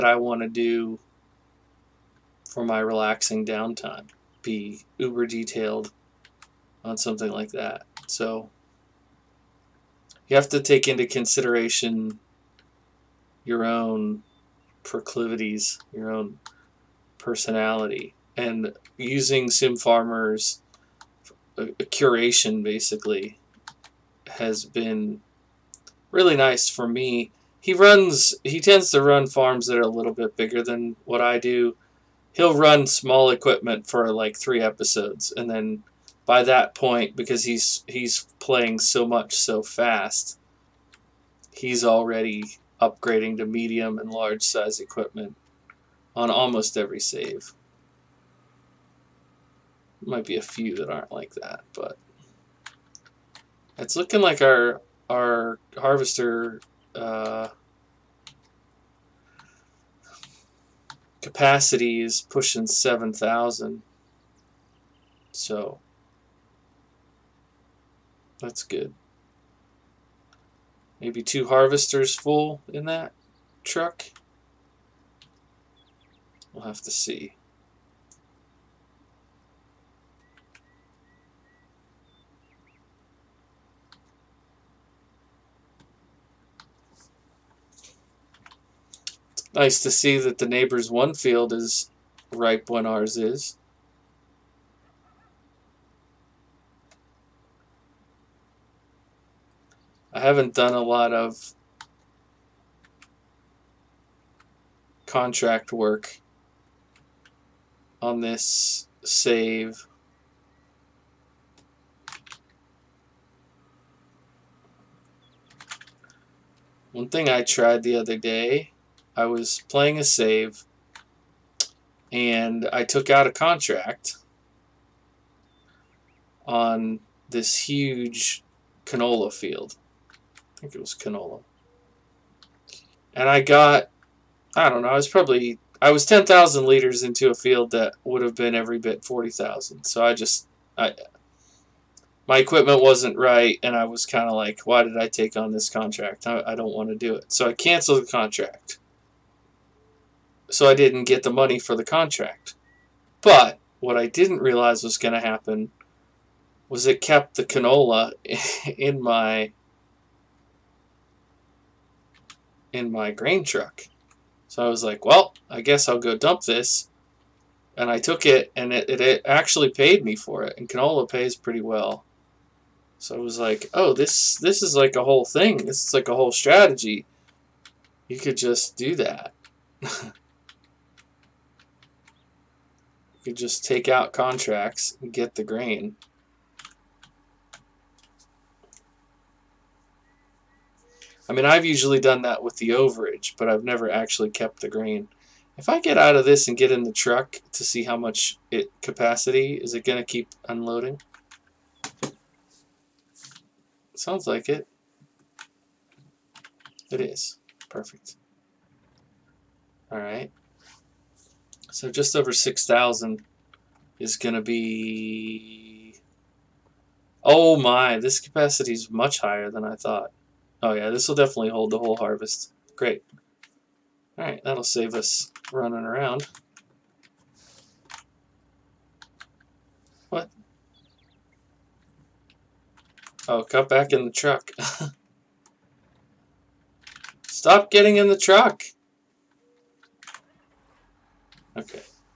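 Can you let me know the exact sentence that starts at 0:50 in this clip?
Might be a few that aren't like that, but it's looking like our our harvester.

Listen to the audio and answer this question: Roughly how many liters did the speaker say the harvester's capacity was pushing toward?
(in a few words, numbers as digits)
7,000.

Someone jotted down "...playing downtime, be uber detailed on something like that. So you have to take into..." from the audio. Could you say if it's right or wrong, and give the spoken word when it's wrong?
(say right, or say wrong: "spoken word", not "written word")
wrong: "relaxing", not "playing".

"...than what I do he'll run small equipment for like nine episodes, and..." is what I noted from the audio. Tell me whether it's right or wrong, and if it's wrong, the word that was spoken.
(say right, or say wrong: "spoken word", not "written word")
wrong: "three", not "nine".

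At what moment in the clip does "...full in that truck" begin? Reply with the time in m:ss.
1:12.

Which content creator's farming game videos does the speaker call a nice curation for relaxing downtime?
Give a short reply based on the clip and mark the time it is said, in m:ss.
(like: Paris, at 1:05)
Sim Farmers, at 0:19.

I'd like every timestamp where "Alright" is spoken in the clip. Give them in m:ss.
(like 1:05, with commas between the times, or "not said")
3:29, 3:44.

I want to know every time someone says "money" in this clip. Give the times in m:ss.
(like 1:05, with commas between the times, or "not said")
2:31.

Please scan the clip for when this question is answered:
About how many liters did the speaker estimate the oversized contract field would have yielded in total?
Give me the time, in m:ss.
2:19.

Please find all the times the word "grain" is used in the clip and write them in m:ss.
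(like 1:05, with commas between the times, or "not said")
2:43, 3:05, 3:14.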